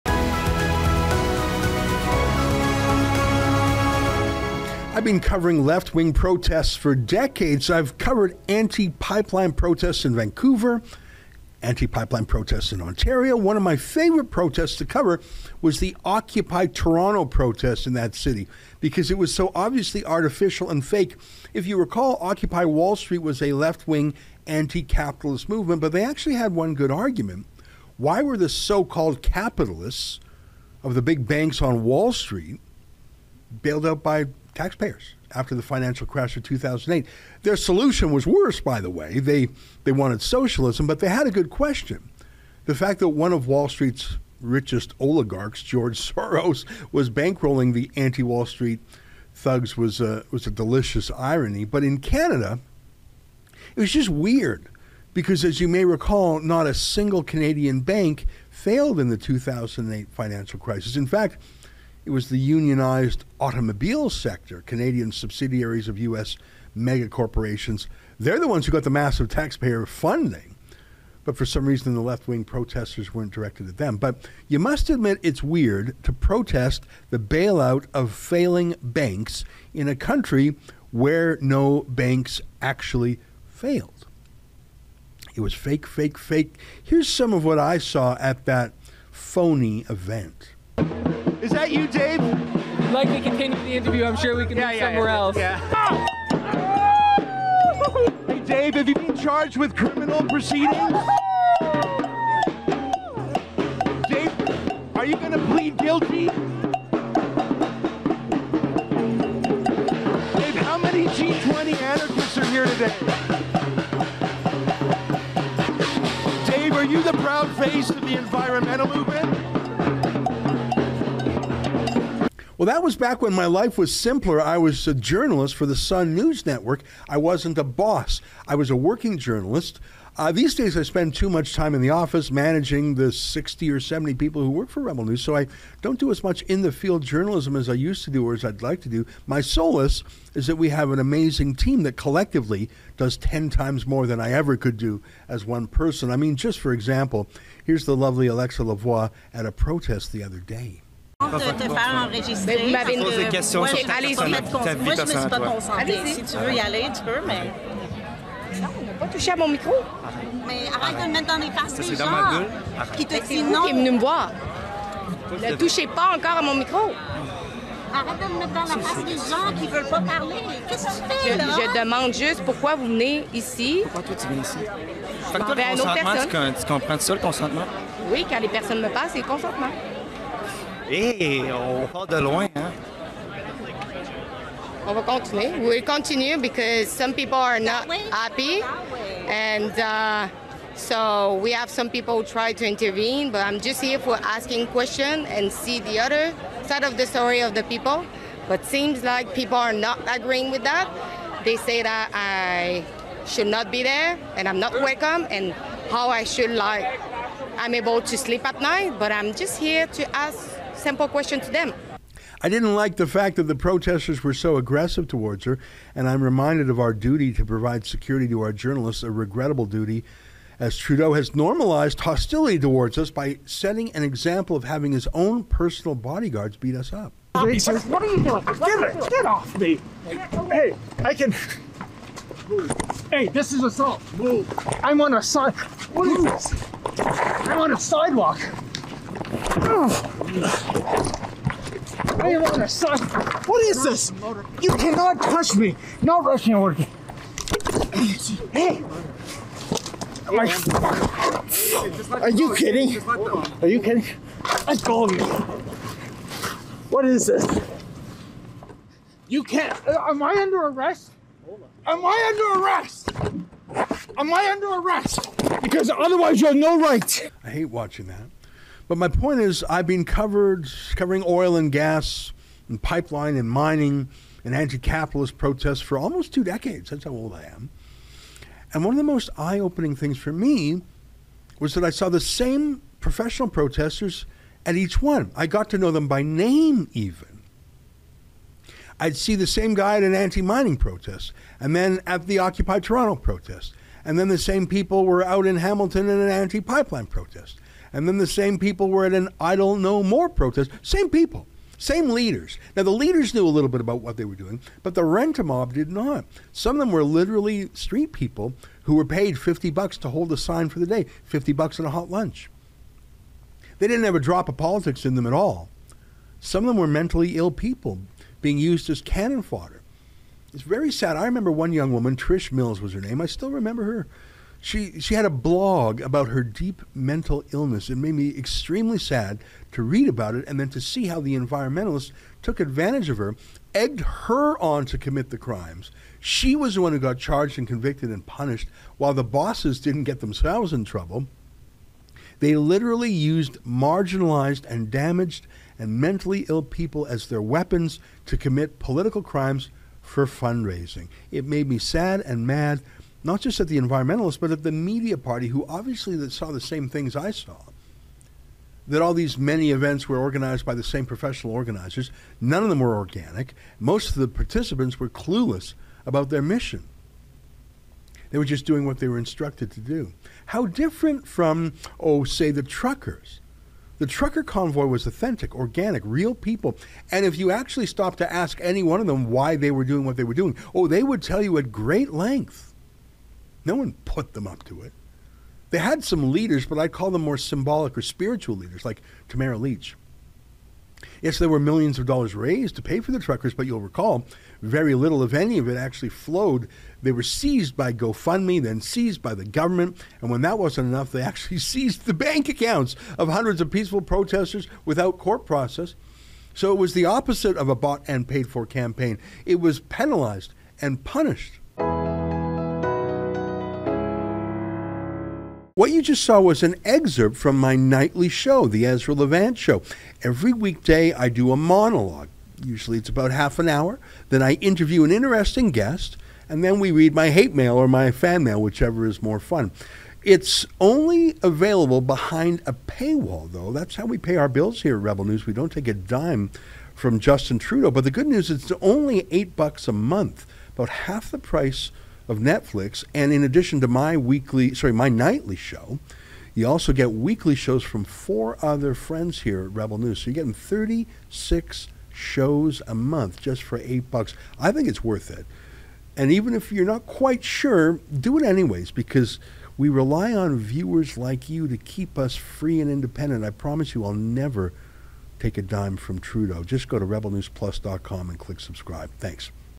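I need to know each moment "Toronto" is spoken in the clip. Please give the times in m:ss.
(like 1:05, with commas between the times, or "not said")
0:16, 4:52.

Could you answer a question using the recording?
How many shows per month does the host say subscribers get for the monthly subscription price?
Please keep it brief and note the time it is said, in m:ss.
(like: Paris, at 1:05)
36, at 7:30.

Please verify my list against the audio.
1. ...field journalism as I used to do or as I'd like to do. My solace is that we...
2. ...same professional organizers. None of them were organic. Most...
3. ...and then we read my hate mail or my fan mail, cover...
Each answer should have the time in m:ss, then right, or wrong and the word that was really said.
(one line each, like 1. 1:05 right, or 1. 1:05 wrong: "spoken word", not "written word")
1. 2:16 right
2. 6:00 right
3. 7:06 wrong: "whichever", not "cover".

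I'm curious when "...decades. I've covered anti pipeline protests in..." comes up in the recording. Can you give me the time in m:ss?
0:06.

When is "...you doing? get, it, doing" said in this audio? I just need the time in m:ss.
3:48.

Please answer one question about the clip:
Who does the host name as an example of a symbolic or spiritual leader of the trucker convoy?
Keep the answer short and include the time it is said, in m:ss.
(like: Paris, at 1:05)
Tamara Lich, at 6:29.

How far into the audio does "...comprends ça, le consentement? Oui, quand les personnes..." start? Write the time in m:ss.
2:56.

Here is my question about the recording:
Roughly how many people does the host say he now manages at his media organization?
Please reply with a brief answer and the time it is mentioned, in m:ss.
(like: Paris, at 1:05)
60 or 70, at 2:13.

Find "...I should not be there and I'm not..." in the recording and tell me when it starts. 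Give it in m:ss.
3:22.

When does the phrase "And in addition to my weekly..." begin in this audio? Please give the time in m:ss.
7:23.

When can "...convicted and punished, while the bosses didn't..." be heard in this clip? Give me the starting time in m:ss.
5:37.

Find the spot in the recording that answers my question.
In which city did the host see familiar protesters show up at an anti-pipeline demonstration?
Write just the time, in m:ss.
4:55.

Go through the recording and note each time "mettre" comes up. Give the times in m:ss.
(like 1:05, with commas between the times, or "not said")
2:41, 2:48.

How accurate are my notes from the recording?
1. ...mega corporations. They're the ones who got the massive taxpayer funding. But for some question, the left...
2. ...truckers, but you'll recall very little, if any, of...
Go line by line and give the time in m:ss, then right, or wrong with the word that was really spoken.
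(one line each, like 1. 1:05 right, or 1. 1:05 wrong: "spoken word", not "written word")
1. 1:06 wrong: "reason", not "question"
2. 6:33 right.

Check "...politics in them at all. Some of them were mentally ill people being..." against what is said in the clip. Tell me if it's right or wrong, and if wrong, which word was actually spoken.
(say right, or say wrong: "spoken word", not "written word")
right.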